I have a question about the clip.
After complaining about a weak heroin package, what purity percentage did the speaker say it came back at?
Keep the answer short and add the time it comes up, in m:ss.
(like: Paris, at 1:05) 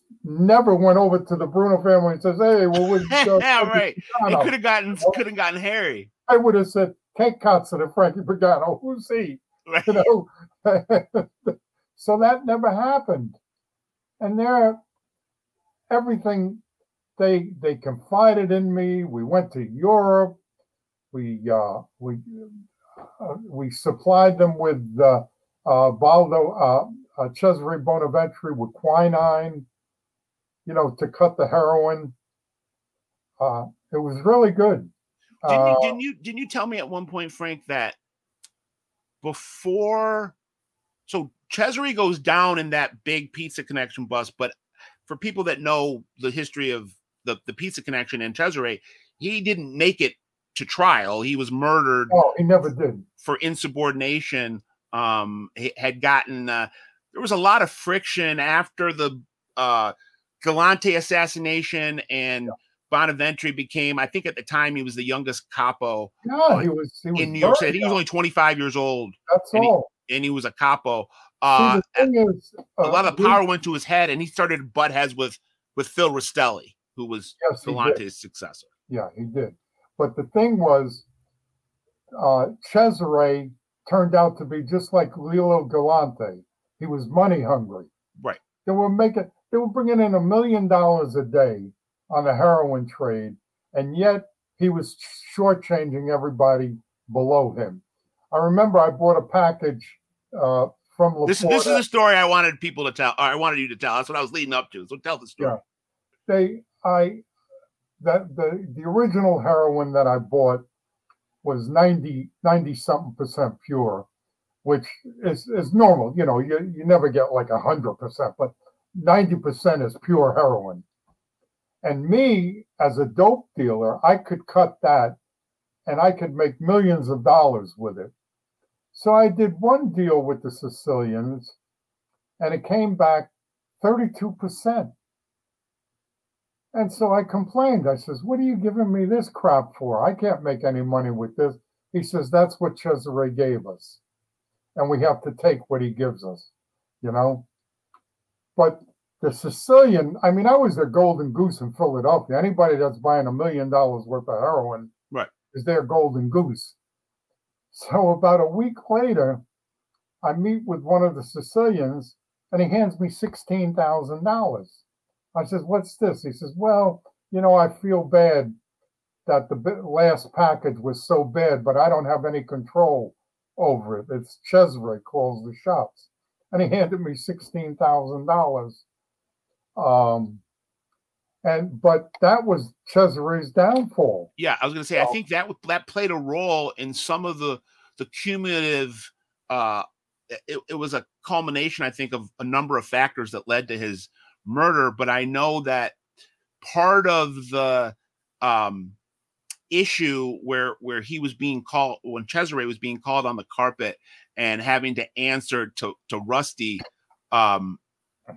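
32%, at 2:13.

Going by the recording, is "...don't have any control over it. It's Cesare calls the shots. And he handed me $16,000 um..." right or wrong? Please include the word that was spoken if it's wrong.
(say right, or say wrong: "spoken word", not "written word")
right.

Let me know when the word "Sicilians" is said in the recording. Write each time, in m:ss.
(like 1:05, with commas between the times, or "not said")
2:10, 2:29, 2:41.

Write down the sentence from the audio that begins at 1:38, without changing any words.
I remember I bought a package uh, from LaPorta.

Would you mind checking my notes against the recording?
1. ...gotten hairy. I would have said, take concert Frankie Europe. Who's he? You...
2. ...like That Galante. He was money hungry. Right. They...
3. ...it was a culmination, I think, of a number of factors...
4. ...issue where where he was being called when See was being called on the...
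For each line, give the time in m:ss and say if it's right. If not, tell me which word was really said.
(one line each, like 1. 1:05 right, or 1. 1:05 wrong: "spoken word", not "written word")
1. 0:05 wrong: "Pagano", not "Europe"
2. 1:24 wrong: "Lilo", not "That"
3. 3:10 right
4. 3:19 wrong: "Cesare", not "See".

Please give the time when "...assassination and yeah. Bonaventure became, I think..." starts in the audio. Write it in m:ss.
1:00.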